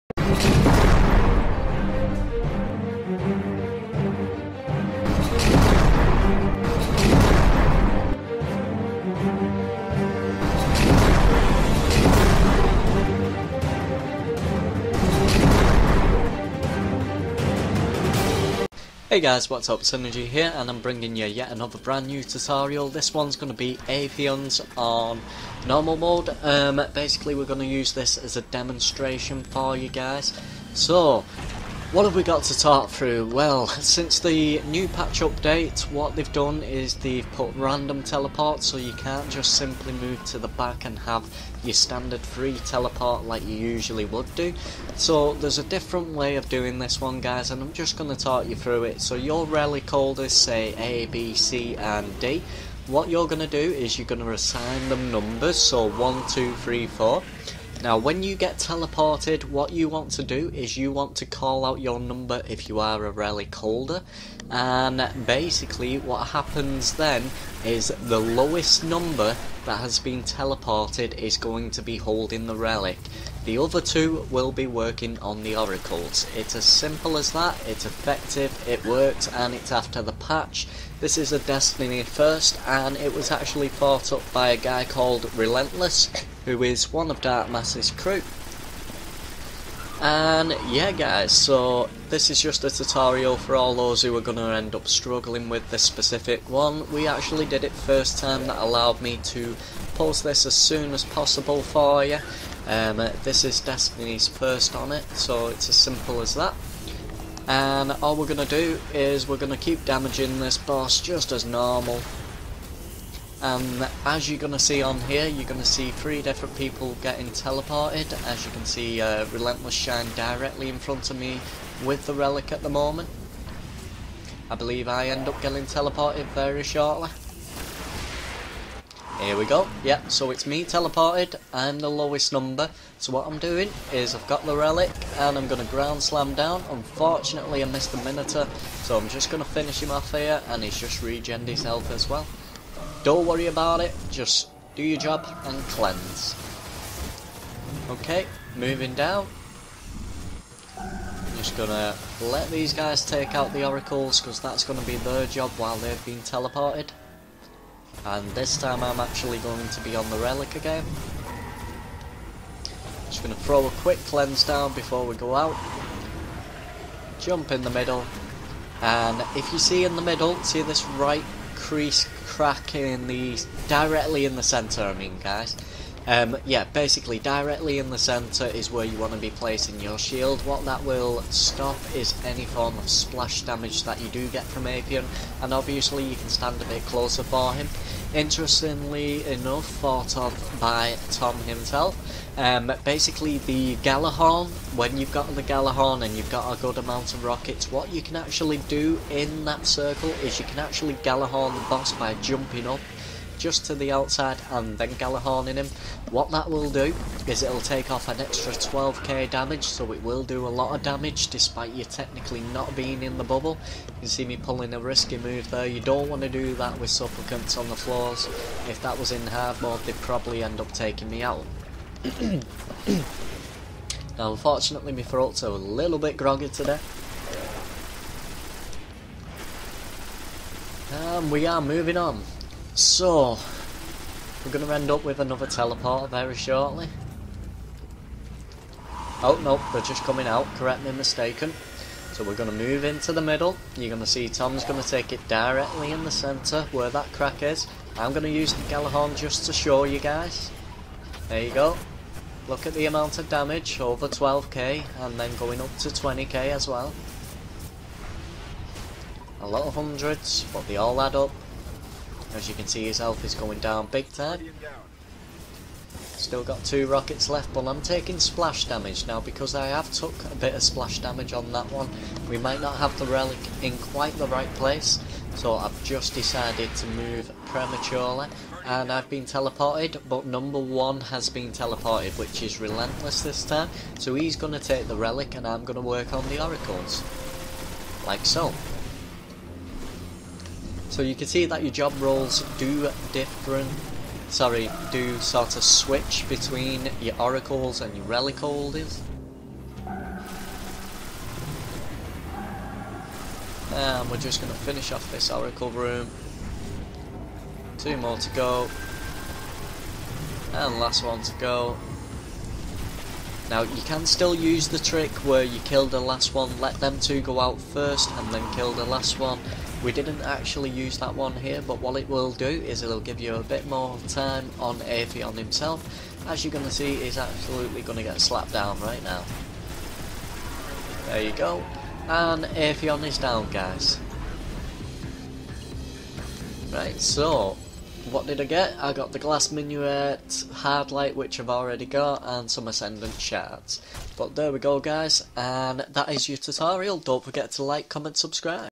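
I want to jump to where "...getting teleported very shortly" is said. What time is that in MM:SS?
02:05.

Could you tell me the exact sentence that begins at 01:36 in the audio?
We actually did it first time that allowed me to post this as soon as possible for you.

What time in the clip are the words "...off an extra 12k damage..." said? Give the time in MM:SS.
03:27.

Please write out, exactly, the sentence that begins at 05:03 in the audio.
And we're just going to finish off this oracle room.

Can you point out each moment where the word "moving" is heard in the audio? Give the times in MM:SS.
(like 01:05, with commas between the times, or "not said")
02:28, 03:51.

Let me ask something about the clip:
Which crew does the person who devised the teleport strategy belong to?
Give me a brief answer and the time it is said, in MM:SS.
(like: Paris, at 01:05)
Dark Mass's crew, at 01:27.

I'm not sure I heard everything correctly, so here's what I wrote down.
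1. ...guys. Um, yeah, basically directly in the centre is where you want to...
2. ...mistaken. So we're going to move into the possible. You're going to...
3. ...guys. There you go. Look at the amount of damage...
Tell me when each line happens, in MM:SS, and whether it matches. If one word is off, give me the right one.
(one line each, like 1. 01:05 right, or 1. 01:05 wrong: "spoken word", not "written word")
1. 02:55 right
2. 04:00 wrong: "middle", not "possible"
3. 04:09 right.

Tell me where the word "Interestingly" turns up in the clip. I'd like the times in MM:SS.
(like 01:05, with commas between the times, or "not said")
03:08.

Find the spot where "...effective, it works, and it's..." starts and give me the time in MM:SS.
01:17.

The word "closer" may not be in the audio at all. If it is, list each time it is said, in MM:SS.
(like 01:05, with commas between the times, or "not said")
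03:06.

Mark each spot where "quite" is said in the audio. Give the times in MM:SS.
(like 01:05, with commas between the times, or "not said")
04:33.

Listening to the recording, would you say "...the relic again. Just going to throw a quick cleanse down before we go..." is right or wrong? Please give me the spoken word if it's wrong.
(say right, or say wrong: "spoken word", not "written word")
right.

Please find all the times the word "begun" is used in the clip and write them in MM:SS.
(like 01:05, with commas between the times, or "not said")
not said.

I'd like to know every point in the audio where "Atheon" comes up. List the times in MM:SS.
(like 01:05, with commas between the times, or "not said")
00:23, 03:04, 05:24, 05:32.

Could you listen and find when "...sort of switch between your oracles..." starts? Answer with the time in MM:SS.
04:55.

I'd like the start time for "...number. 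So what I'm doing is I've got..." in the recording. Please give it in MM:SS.
02:12.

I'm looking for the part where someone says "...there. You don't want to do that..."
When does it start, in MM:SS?
03:35.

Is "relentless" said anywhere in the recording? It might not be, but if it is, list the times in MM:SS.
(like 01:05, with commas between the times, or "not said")
01:25, 01:59, 04:42.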